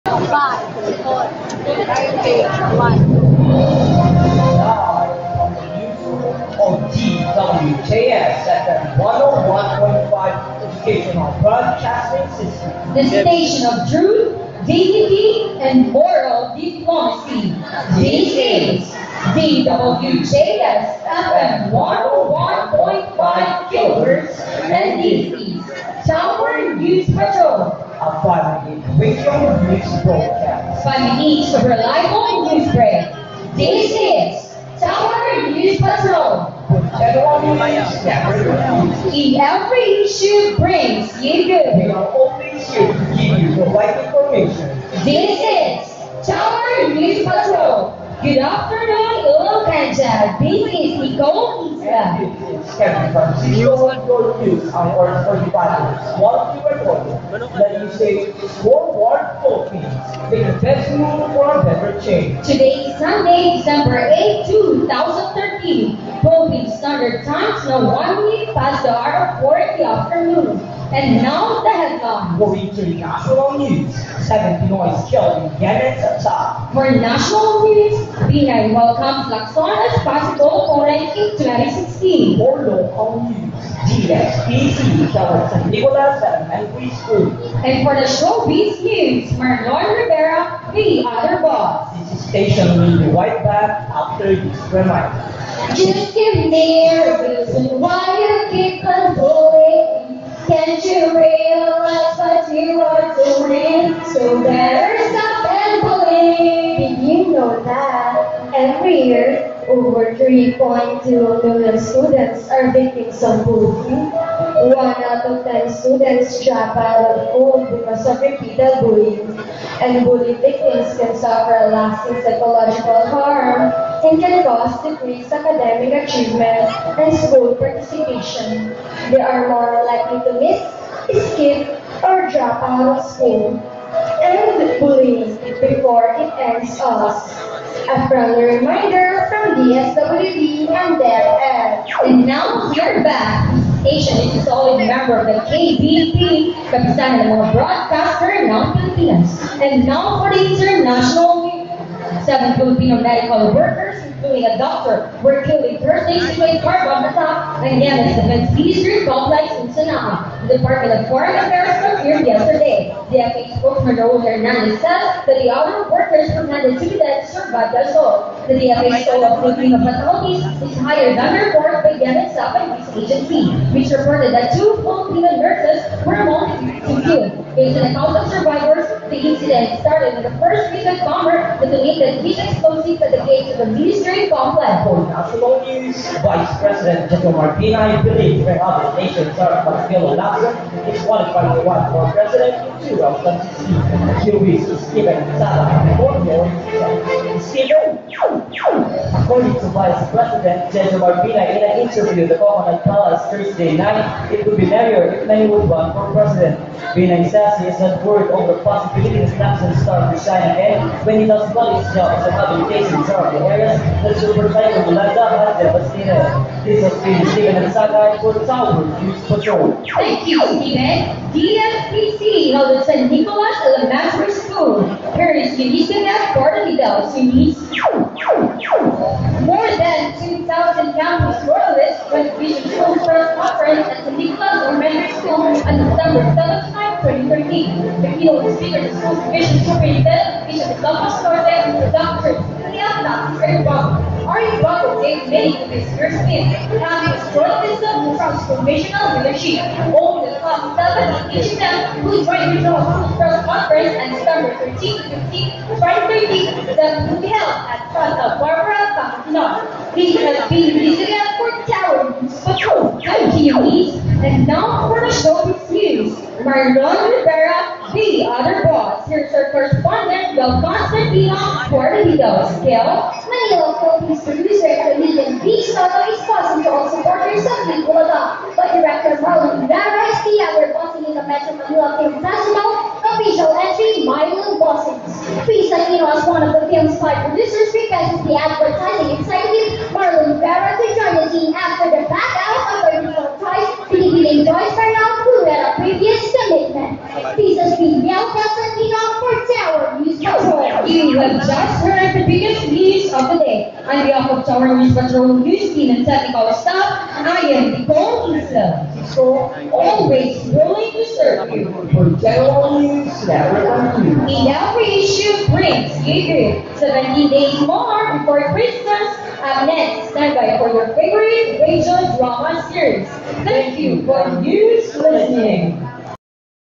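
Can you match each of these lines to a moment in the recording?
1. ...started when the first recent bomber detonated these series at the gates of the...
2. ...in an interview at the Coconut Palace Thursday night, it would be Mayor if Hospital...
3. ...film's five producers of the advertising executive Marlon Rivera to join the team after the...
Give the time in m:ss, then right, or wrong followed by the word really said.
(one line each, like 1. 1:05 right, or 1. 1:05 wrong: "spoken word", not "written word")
1. 2:59 wrong: "explosives", not "series"
2. 3:21 wrong: "May", not "Hospital"
3. 4:46 right.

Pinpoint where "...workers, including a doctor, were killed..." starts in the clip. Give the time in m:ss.
2:33.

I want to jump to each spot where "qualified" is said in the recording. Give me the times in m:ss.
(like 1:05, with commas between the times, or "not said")
3:11.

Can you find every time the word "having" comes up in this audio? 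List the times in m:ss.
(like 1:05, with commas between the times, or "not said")
4:06.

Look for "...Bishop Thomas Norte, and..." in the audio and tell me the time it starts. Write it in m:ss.
4:00.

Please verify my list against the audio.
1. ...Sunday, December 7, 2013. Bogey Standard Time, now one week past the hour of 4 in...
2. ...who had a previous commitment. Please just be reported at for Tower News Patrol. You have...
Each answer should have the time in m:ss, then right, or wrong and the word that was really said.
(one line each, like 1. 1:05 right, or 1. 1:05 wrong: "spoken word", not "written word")
1. 1:02 wrong: "8", not "7"
2. 4:55 wrong: "yelled", not "reported".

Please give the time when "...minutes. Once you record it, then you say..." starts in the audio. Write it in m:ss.
0:55.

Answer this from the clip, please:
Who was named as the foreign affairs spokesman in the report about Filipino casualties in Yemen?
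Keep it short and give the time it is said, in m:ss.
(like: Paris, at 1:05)
Raul Hernandez, at 2:43.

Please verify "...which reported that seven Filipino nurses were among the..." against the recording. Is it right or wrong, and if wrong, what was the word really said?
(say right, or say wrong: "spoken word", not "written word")
wrong: "two", not "seven".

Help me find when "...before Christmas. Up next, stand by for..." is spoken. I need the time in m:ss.
5:18.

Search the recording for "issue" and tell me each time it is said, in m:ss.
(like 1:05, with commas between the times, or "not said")
0:40, 5:15.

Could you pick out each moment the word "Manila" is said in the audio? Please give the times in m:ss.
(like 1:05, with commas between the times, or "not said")
4:33, 4:41.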